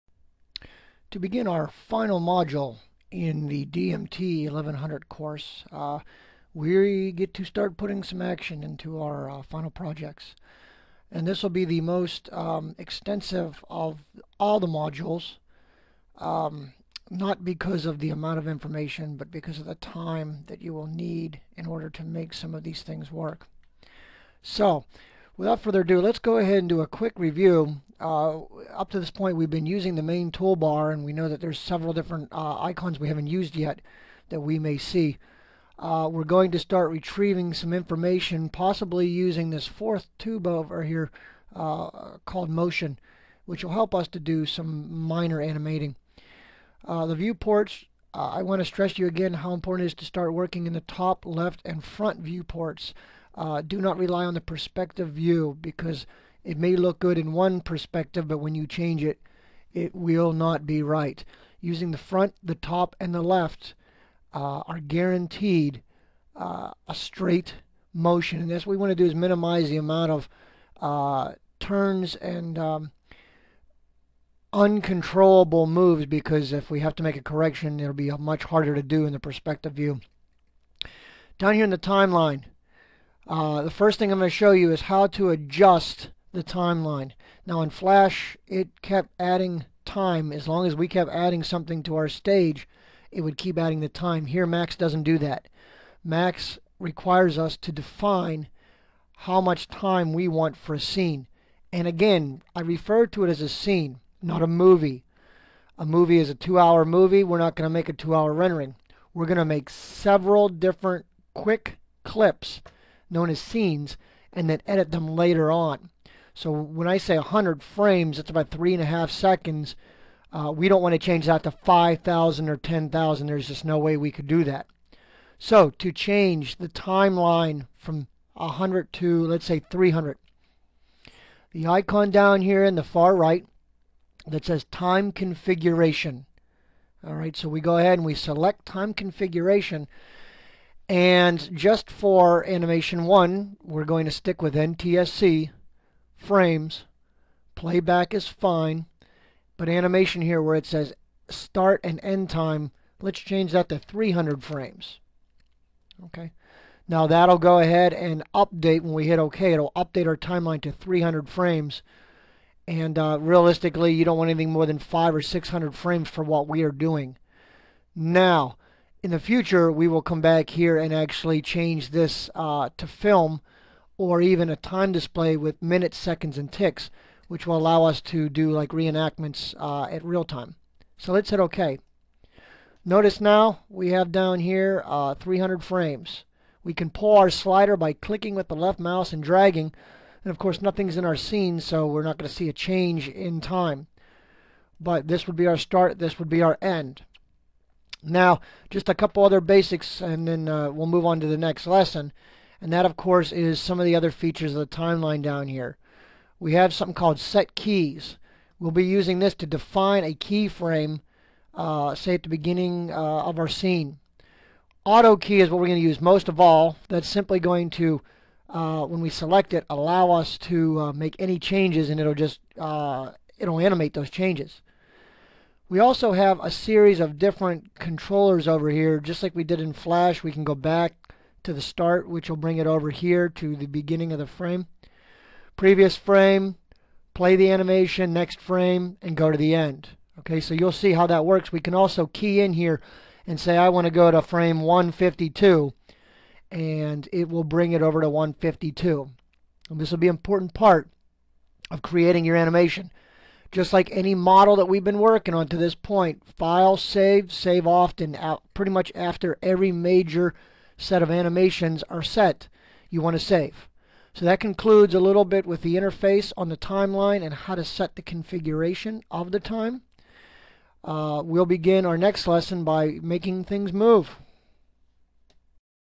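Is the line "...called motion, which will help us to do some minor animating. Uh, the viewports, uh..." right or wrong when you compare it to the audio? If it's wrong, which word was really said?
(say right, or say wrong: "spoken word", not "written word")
right.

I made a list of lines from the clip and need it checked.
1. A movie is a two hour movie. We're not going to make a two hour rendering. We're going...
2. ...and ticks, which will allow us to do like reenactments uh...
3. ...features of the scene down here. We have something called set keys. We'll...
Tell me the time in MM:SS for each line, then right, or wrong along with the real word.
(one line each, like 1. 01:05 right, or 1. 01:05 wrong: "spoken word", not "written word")
1. 01:45 right
2. 02:56 right
3. 03:24 wrong: "timeline", not "scene".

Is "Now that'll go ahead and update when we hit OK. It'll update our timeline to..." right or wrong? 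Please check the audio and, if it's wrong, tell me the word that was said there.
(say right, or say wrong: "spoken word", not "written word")
right.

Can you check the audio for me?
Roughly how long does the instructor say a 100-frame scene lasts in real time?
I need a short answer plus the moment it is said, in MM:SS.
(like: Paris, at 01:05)
3.5 seconds, at 01:58.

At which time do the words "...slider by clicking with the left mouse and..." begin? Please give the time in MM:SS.
03:07.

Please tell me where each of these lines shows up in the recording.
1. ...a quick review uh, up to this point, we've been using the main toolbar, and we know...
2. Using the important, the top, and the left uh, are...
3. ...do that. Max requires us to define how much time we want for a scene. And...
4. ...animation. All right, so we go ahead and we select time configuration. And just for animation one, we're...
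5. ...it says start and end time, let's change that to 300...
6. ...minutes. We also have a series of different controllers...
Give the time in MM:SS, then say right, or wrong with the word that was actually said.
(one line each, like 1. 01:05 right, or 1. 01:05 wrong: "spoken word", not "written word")
1. 00:26 right
2. 01:01 wrong: "front", not "important"
3. 01:35 right
4. 02:15 wrong: "configuration", not "animation"
5. 02:30 right
6. 03:44 wrong: "changes", not "minutes".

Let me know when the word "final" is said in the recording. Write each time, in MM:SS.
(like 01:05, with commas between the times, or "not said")
00:01, 00:09.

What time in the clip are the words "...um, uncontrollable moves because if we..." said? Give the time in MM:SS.
01:12.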